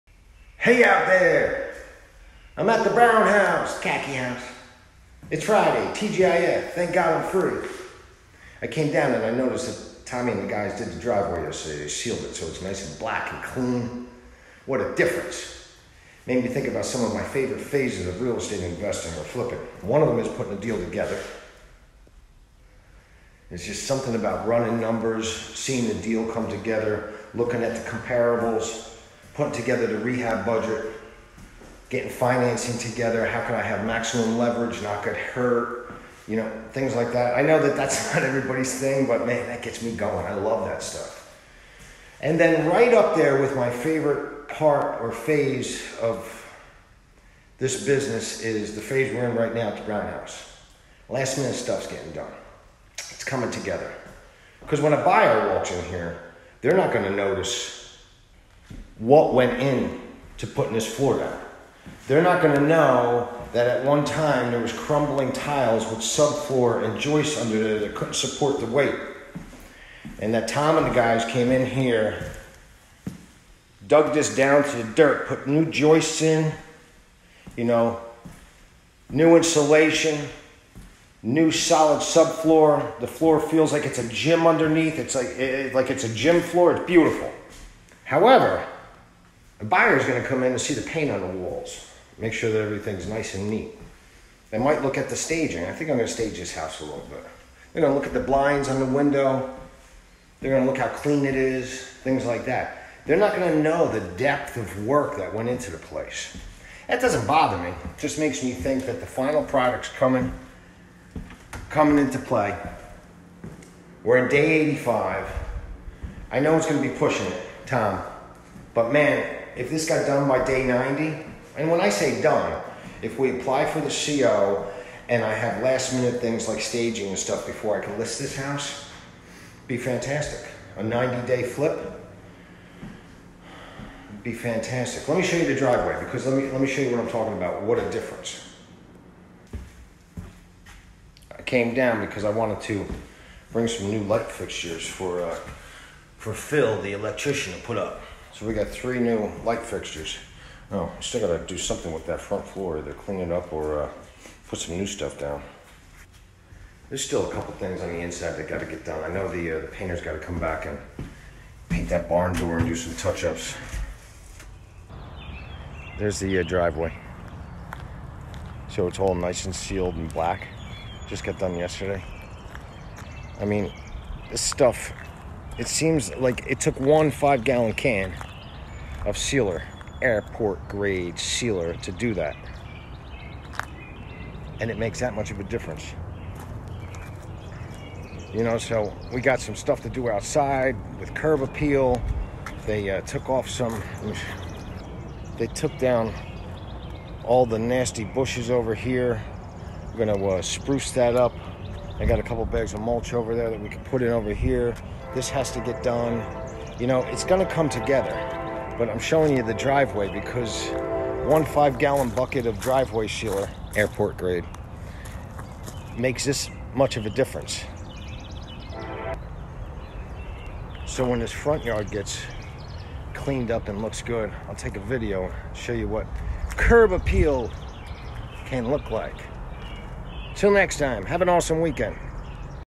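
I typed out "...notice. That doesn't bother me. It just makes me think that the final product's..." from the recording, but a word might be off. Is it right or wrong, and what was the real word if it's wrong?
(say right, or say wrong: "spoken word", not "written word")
wrong: "place", not "notice".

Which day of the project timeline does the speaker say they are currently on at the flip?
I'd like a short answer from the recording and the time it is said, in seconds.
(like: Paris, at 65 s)
85, at 114 s.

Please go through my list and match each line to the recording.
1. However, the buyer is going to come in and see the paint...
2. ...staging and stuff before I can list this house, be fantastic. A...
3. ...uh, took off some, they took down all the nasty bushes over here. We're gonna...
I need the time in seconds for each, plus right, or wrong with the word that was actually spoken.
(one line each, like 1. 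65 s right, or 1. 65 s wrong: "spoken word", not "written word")
1. 88 s right
2. 126 s right
3. 192 s right.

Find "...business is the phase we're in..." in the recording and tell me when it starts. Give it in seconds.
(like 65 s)
47 s.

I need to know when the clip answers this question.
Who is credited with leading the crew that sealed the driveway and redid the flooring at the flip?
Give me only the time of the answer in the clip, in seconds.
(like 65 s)
10 s.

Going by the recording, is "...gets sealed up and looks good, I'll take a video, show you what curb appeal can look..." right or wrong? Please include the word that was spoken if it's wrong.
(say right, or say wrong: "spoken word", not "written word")
wrong: "cleaned", not "sealed".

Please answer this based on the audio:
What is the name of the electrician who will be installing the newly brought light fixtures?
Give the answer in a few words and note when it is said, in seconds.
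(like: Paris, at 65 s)
Phil, at 146 s.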